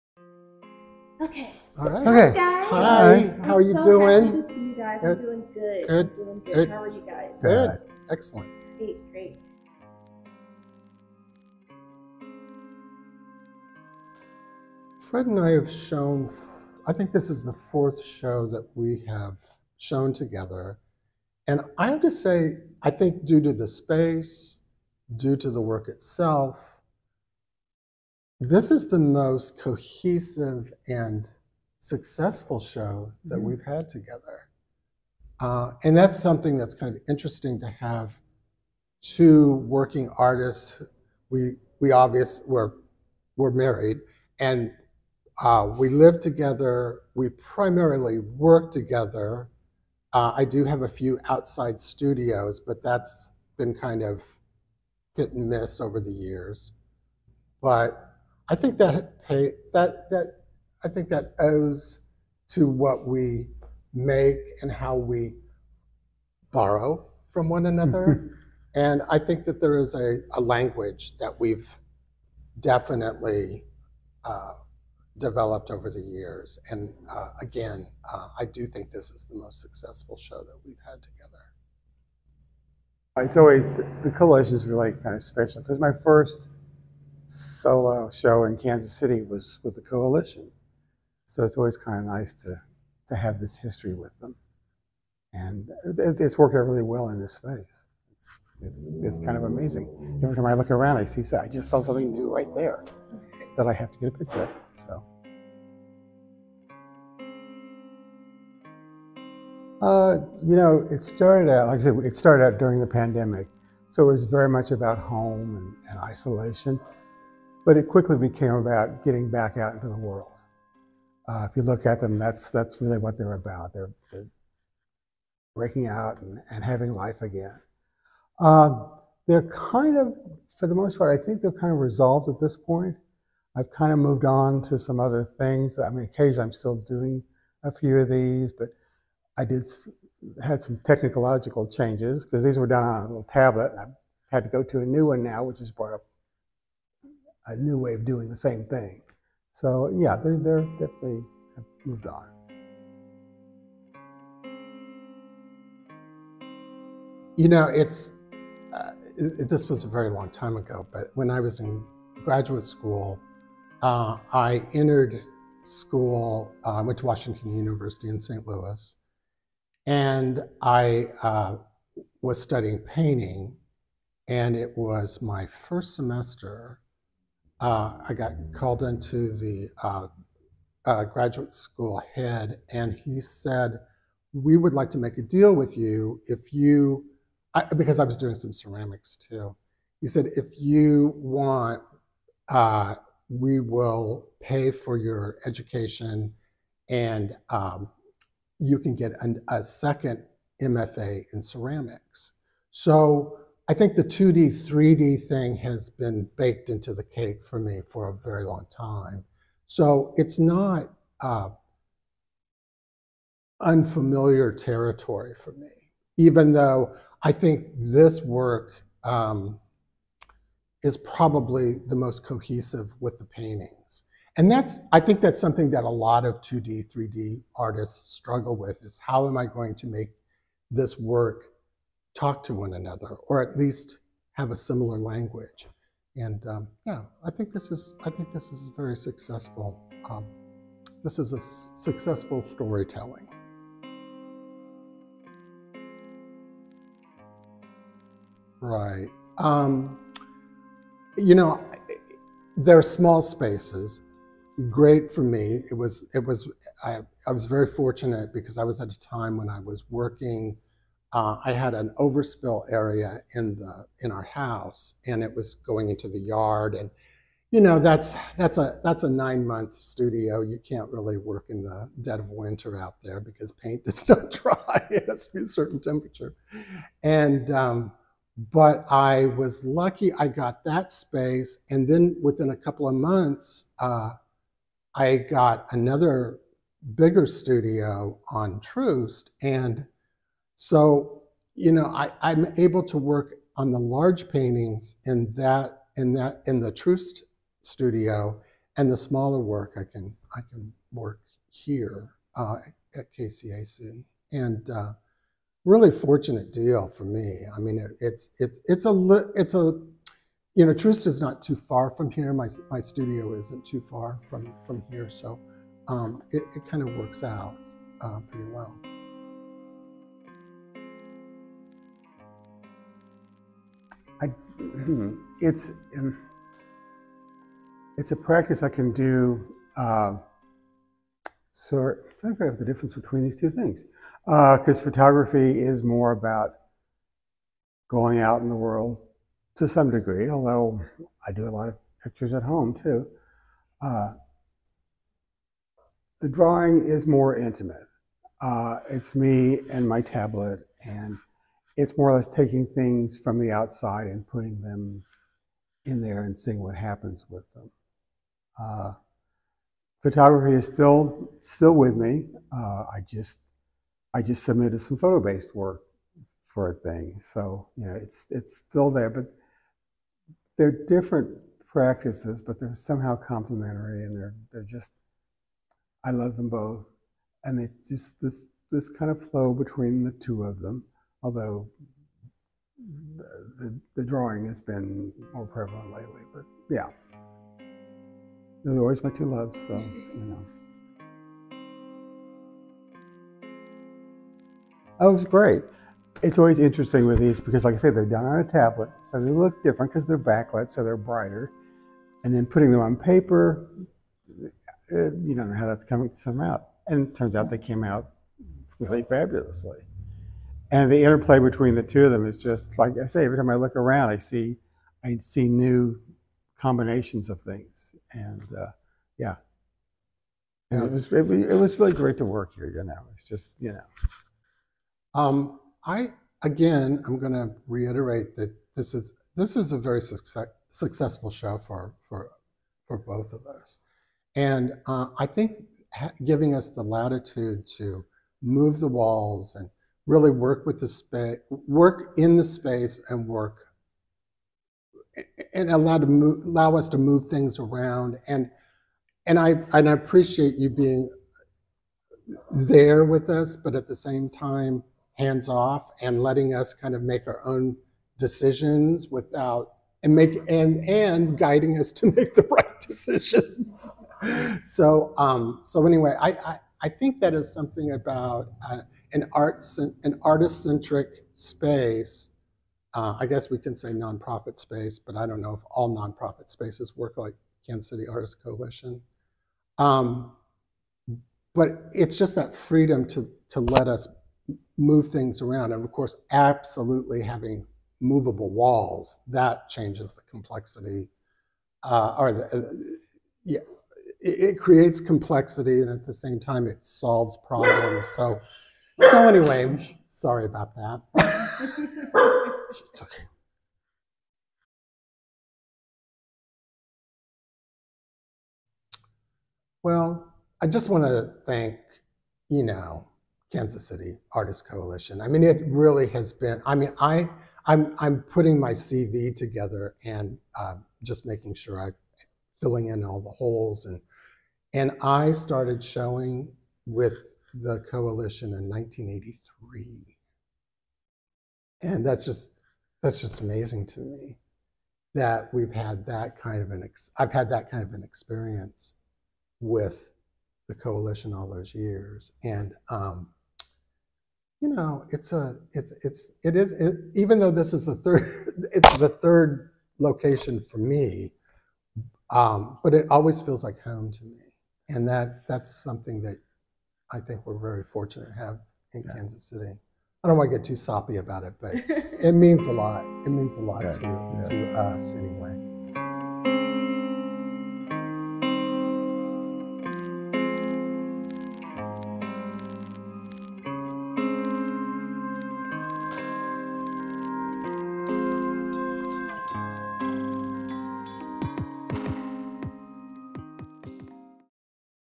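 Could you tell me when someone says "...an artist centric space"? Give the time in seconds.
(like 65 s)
470 s.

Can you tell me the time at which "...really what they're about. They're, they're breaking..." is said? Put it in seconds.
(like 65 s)
122 s.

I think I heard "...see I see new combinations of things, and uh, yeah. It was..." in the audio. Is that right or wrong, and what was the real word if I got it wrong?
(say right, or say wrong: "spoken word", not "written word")
right.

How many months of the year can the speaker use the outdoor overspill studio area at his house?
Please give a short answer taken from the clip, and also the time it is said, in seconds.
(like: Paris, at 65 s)
9, at 269 s.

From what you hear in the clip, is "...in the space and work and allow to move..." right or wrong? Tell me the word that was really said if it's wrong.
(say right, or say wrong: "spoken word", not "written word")
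right.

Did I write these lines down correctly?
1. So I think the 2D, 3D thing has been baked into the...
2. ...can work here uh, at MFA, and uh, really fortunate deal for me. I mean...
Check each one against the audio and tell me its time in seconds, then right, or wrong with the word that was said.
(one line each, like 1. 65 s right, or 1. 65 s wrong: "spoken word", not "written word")
1. 202 s right
2. 300 s wrong: "KCAC", not "MFA".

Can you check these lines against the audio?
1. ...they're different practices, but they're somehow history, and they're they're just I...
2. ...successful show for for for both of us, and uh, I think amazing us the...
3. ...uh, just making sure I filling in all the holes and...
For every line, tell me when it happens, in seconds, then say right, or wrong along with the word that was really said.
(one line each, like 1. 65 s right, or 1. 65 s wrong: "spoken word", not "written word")
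1. 370 s wrong: "complementary", not "history"
2. 430 s wrong: "giving", not "amazing"
3. 520 s right.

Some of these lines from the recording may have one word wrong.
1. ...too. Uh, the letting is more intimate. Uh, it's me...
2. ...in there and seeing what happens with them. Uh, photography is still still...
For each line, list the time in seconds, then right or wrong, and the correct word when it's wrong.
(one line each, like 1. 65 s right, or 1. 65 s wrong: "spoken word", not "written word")
1. 342 s wrong: "drawing", not "letting"
2. 355 s right.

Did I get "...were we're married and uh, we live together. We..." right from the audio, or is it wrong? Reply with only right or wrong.
right.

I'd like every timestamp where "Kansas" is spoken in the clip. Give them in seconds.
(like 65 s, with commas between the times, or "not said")
88 s, 477 s, 513 s, 559 s.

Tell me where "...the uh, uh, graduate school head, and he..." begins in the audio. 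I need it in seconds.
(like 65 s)
179 s.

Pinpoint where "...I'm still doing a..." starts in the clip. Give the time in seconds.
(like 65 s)
136 s.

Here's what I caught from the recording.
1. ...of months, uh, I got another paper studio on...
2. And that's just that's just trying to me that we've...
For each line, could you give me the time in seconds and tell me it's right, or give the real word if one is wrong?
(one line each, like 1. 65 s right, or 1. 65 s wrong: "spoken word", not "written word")
1. 282 s wrong: "bigger", not "paper"
2. 531 s wrong: "amazing", not "trying".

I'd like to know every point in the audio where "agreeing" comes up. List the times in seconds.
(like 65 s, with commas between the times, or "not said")
not said.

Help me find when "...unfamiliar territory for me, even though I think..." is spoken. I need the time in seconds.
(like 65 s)
213 s.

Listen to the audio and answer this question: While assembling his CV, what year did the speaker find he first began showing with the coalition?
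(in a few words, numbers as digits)
1983.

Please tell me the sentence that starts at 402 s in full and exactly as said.
And then putting them on paper, uh, you don't know how that's coming to come out.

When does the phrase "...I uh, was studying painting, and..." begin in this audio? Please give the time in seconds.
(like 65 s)
170 s.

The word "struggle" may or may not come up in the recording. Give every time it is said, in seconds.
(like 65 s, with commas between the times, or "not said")
228 s.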